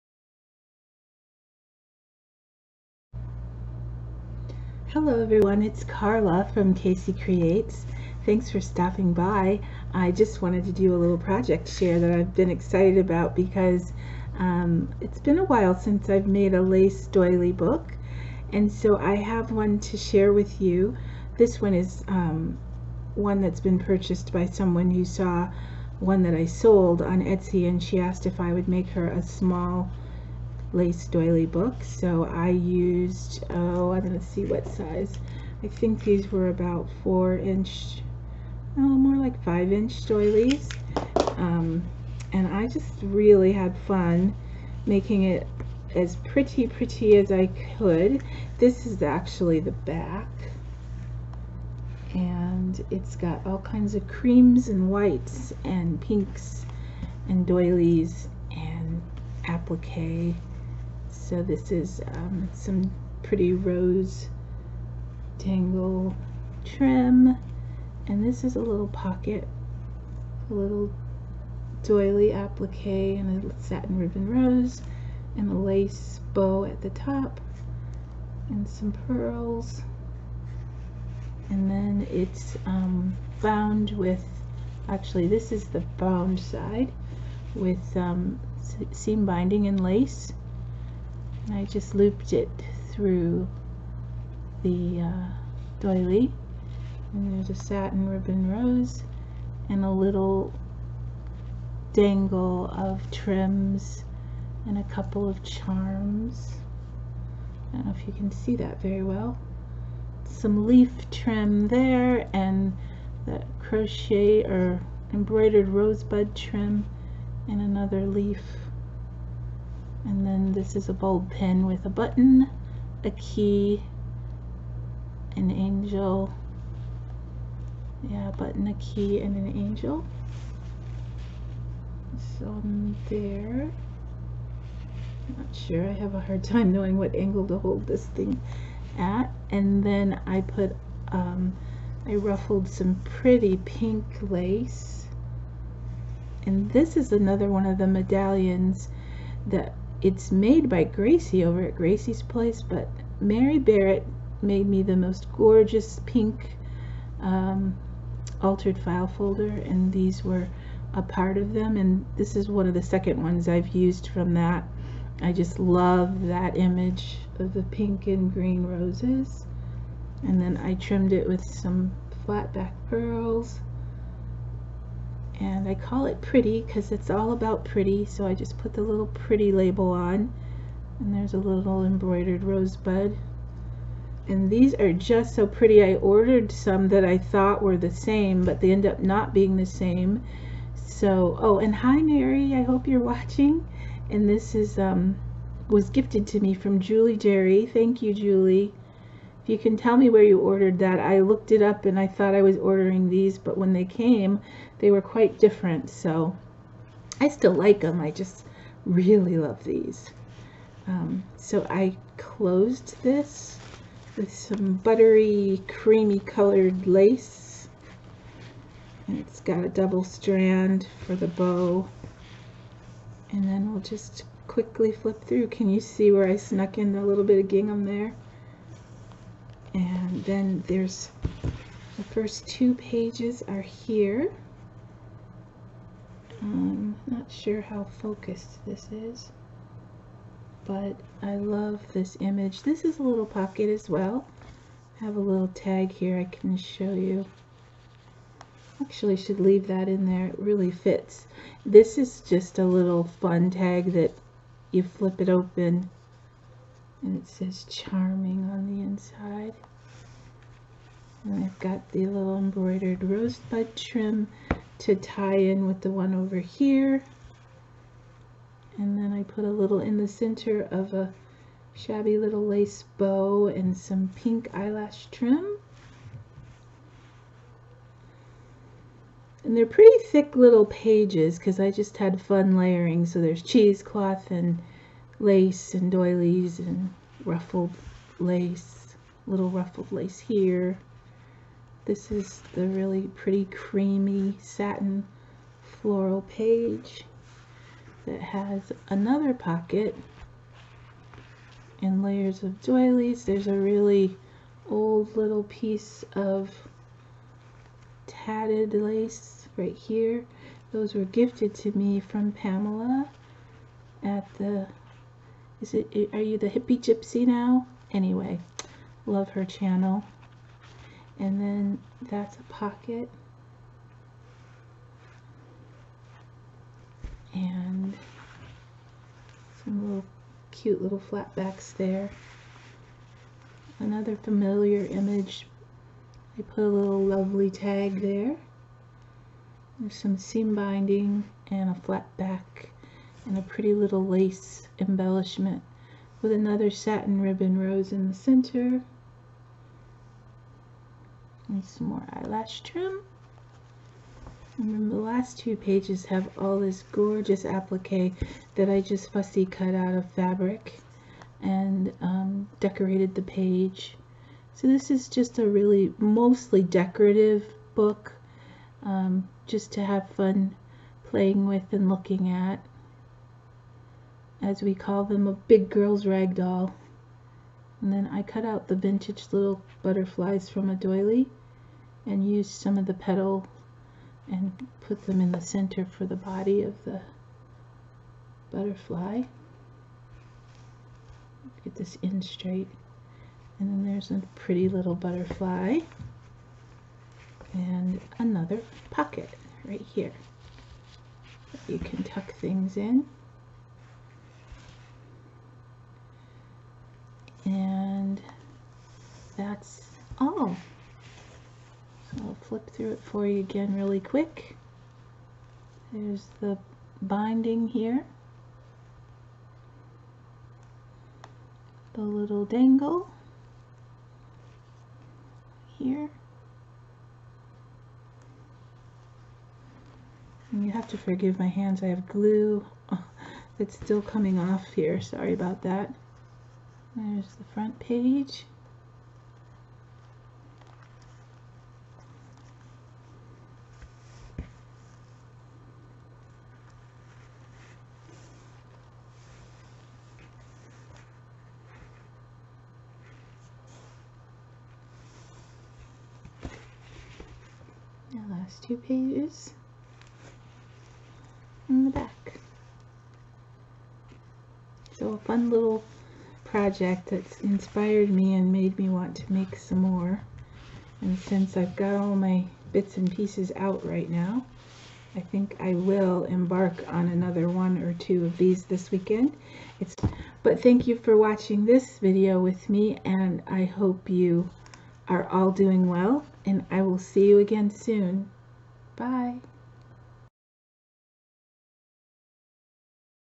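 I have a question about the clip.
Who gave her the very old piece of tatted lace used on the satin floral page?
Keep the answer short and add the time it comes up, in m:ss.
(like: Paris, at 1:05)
Pamela, at 5:12.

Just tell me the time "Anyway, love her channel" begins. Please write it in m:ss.
5:17.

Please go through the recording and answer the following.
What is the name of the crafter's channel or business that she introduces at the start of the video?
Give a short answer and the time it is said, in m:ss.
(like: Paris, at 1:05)
KC Creates, at 0:06.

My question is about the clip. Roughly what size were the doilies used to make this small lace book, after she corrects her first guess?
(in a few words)
5 inch.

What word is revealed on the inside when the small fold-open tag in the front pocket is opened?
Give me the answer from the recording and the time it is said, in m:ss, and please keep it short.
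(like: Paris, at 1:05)
charming, at 4:17.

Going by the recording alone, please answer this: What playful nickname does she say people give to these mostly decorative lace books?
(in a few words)
a big girl's rag doll.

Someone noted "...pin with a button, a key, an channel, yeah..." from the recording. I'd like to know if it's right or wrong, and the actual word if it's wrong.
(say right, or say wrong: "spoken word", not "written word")
wrong: "angel", not "channel".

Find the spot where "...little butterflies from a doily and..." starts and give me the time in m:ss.
6:19.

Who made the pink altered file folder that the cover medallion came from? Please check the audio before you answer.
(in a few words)
Mary Barrett.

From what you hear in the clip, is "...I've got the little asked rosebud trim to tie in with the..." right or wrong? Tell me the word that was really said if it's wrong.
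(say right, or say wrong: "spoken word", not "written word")
wrong: "embroidered", not "asked".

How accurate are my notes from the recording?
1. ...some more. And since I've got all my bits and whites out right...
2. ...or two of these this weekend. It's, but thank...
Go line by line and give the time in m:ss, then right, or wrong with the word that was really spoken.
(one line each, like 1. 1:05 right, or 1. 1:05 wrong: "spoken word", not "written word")
1. 7:49 wrong: "pieces", not "whites"
2. 7:57 right.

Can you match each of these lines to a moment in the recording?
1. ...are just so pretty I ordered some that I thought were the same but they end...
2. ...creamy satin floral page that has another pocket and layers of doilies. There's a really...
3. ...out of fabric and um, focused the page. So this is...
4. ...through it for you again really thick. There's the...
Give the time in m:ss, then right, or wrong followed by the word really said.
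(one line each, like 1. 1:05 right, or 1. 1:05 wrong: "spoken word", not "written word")
1. 3:04 right
2. 4:53 right
3. 5:59 wrong: "decorated", not "focused"
4. 6:52 wrong: "quick", not "thick".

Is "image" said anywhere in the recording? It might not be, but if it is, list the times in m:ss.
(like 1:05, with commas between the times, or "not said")
2:46, 4:02, 5:34.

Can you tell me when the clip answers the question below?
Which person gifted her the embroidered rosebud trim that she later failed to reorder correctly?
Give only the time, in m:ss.
3:16.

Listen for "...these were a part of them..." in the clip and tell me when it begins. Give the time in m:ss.
2:39.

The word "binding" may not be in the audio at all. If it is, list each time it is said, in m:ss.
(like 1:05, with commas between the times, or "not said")
1:29, 5:40, 6:57.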